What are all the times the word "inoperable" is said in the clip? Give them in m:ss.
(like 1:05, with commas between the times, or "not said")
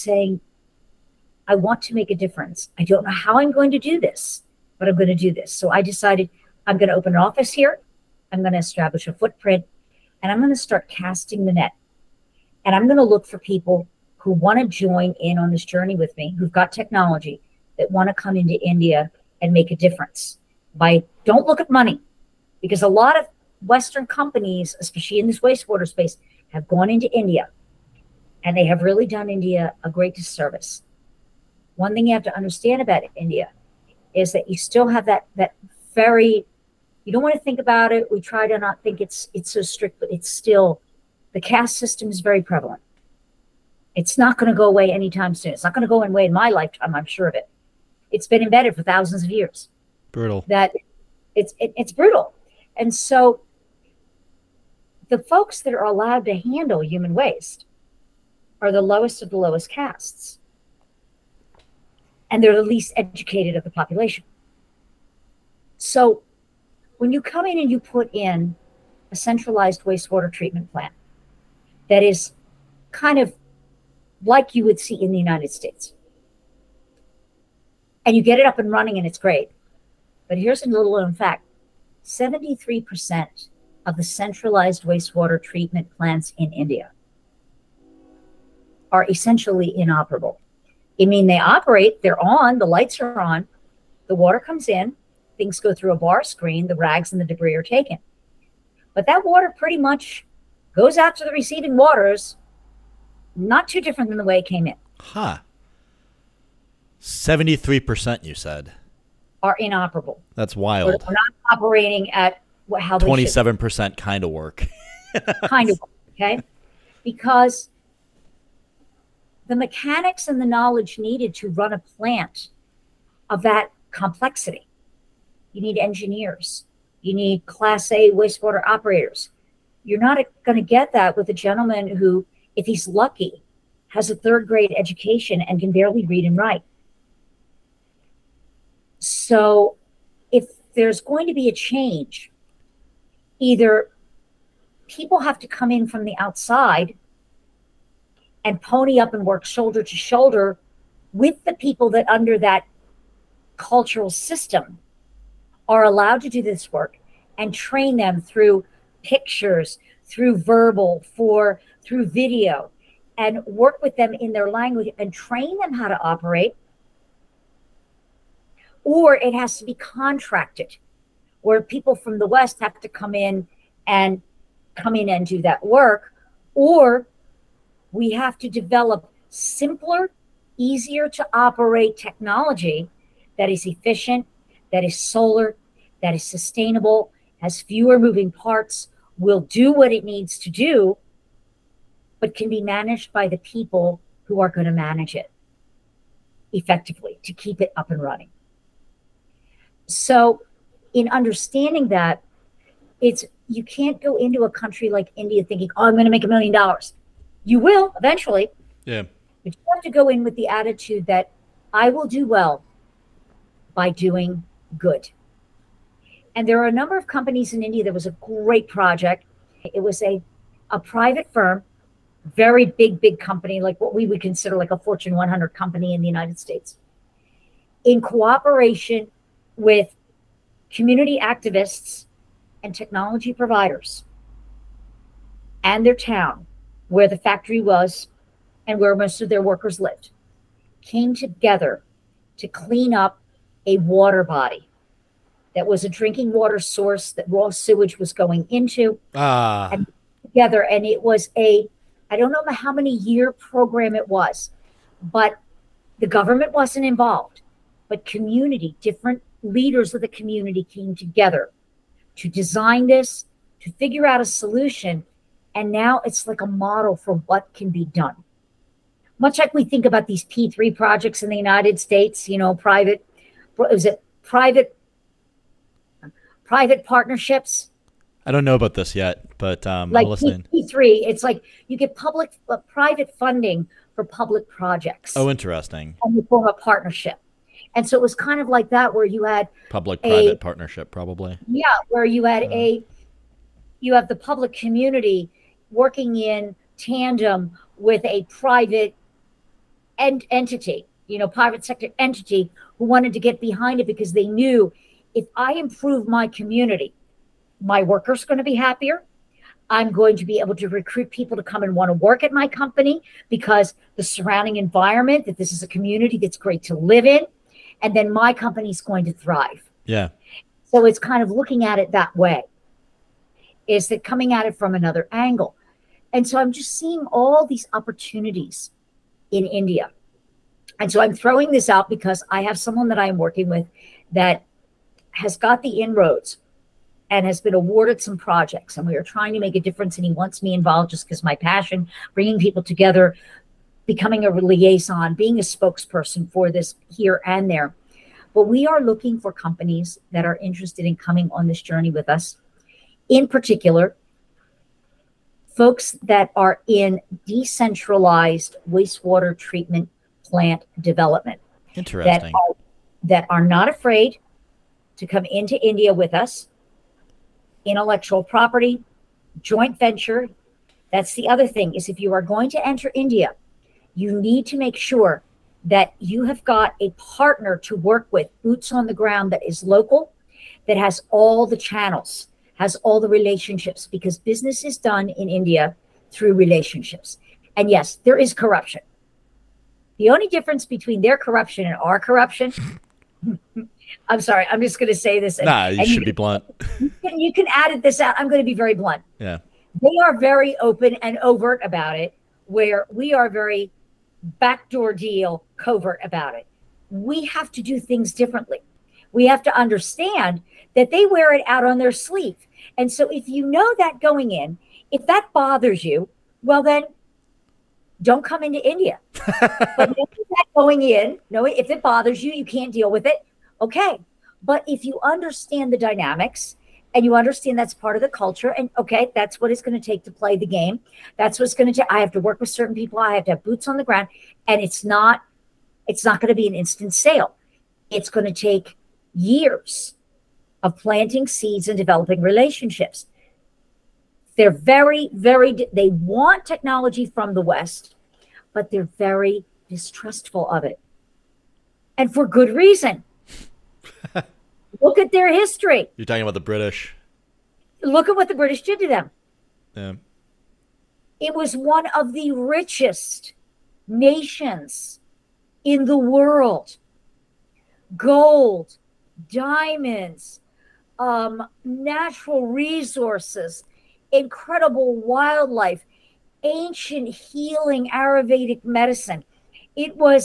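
1:29, 1:49.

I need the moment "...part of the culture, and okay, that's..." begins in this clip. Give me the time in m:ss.
7:07.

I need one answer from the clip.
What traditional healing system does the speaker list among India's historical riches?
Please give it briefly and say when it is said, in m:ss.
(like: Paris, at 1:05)
Ayurvedic medicine, at 7:57.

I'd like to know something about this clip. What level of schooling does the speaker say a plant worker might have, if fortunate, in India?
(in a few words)
third grade.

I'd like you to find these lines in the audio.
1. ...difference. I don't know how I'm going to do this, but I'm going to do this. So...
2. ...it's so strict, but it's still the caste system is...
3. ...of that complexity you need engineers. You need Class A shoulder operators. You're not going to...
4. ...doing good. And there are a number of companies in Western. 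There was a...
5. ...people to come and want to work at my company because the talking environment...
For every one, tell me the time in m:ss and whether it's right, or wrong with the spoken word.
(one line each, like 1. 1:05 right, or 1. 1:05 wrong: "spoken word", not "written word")
1. 0:02 right
2. 0:39 right
3. 2:03 wrong: "wastewater", not "shoulder"
4. 3:33 wrong: "India", not "Western"
5. 5:11 wrong: "surrounding", not "talking".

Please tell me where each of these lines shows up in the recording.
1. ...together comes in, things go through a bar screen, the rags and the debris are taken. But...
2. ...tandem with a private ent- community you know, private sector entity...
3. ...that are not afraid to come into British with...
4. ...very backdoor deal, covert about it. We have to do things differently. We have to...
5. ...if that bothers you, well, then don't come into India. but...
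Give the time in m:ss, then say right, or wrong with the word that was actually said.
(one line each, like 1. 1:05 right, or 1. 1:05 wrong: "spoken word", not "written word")
1. 1:34 wrong: "water", not "together"
2. 4:56 wrong: "entity", not "community"
3. 6:03 wrong: "India", not "British"
4. 6:43 right
5. 6:54 right.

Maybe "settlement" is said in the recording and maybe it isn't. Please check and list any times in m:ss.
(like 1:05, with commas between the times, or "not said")
not said.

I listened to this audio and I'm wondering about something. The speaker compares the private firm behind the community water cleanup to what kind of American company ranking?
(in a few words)
Fortune 100.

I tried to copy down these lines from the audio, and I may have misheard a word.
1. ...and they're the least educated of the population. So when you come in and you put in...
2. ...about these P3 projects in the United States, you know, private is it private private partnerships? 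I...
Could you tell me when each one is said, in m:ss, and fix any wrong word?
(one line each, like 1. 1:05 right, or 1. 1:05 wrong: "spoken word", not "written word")
1. 1:02 right
2. 4:29 right.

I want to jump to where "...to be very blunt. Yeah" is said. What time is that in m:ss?
6:38.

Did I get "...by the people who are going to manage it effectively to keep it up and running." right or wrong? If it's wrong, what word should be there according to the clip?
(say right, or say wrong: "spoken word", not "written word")
right.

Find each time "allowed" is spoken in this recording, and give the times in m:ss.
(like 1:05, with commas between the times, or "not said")
0:55, 2:35.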